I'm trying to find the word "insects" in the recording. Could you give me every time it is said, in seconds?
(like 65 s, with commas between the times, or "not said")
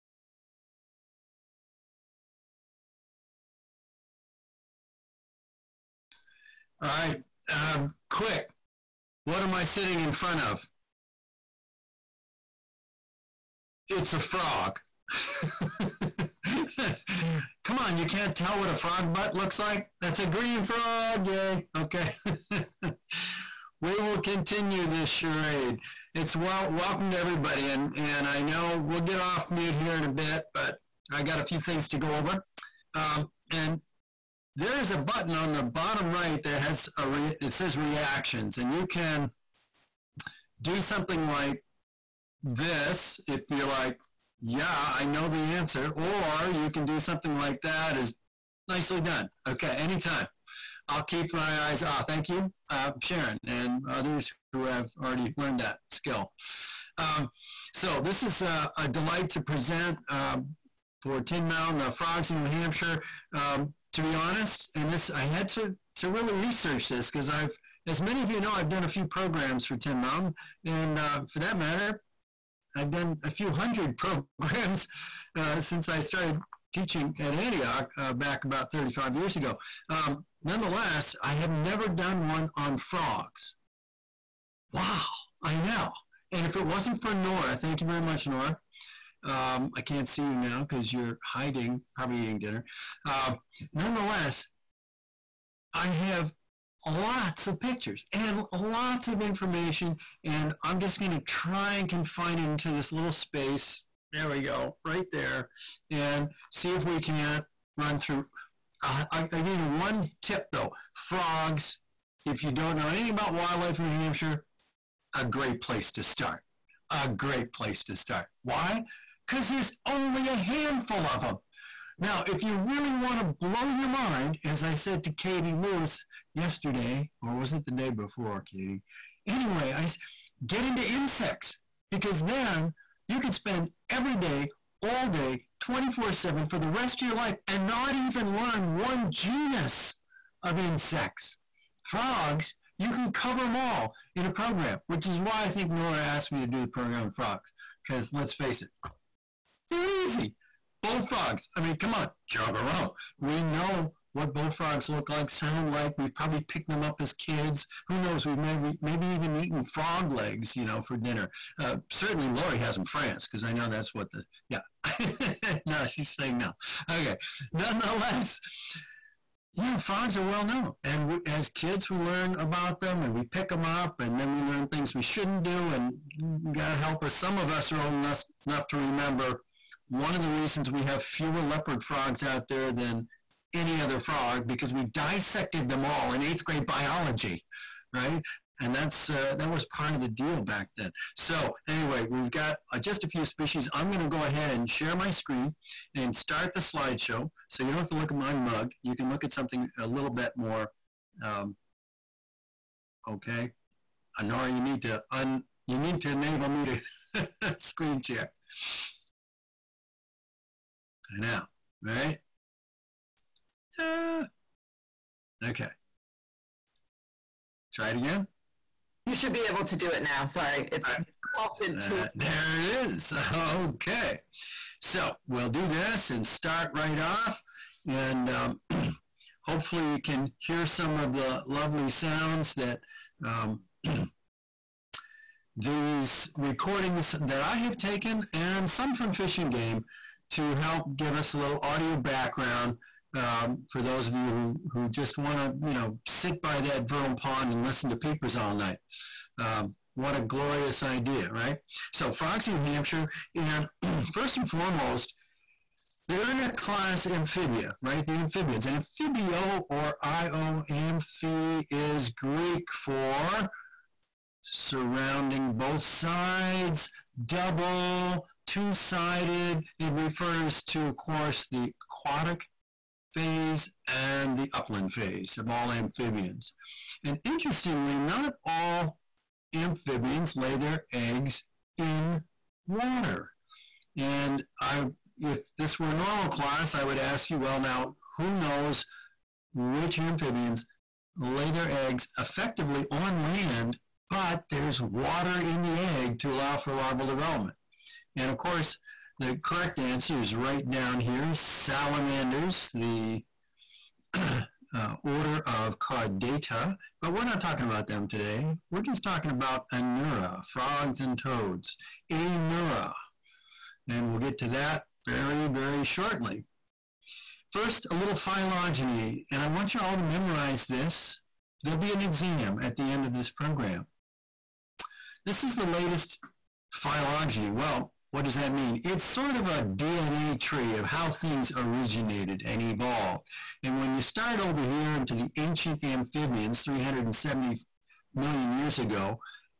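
130 s, 140 s.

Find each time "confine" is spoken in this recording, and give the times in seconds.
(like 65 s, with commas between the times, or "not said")
101 s.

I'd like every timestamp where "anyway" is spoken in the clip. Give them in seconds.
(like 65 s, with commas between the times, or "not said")
129 s, 191 s.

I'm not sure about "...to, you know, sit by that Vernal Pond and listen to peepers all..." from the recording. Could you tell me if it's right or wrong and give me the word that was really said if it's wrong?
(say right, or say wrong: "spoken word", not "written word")
right.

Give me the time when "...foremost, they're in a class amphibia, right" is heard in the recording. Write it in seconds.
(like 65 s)
254 s.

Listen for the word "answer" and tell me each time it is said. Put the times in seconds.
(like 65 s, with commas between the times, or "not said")
45 s, 299 s.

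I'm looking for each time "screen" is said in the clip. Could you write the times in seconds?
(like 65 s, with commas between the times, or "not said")
195 s, 207 s.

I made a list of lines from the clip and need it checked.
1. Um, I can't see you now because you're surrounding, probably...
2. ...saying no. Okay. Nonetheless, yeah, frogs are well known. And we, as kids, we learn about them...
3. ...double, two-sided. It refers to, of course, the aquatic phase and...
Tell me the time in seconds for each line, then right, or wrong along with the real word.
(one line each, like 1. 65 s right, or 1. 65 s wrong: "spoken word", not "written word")
1. 89 s wrong: "hiding", not "surrounding"
2. 166 s right
3. 267 s right.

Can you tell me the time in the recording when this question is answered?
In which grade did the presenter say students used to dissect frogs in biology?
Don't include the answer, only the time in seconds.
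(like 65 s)
186 s.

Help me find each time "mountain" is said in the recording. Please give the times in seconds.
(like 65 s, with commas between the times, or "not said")
61 s, 69 s.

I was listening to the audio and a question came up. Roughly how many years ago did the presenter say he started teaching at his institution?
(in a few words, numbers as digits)
35.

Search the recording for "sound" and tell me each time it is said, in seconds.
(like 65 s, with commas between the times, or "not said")
155 s, 231 s.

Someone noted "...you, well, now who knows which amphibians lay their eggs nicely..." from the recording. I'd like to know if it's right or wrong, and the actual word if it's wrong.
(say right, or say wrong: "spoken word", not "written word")
wrong: "effectively", not "nicely".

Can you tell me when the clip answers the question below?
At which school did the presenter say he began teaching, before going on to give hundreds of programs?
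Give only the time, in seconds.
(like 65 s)
77 s.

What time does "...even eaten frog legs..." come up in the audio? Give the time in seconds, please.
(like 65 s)
159 s.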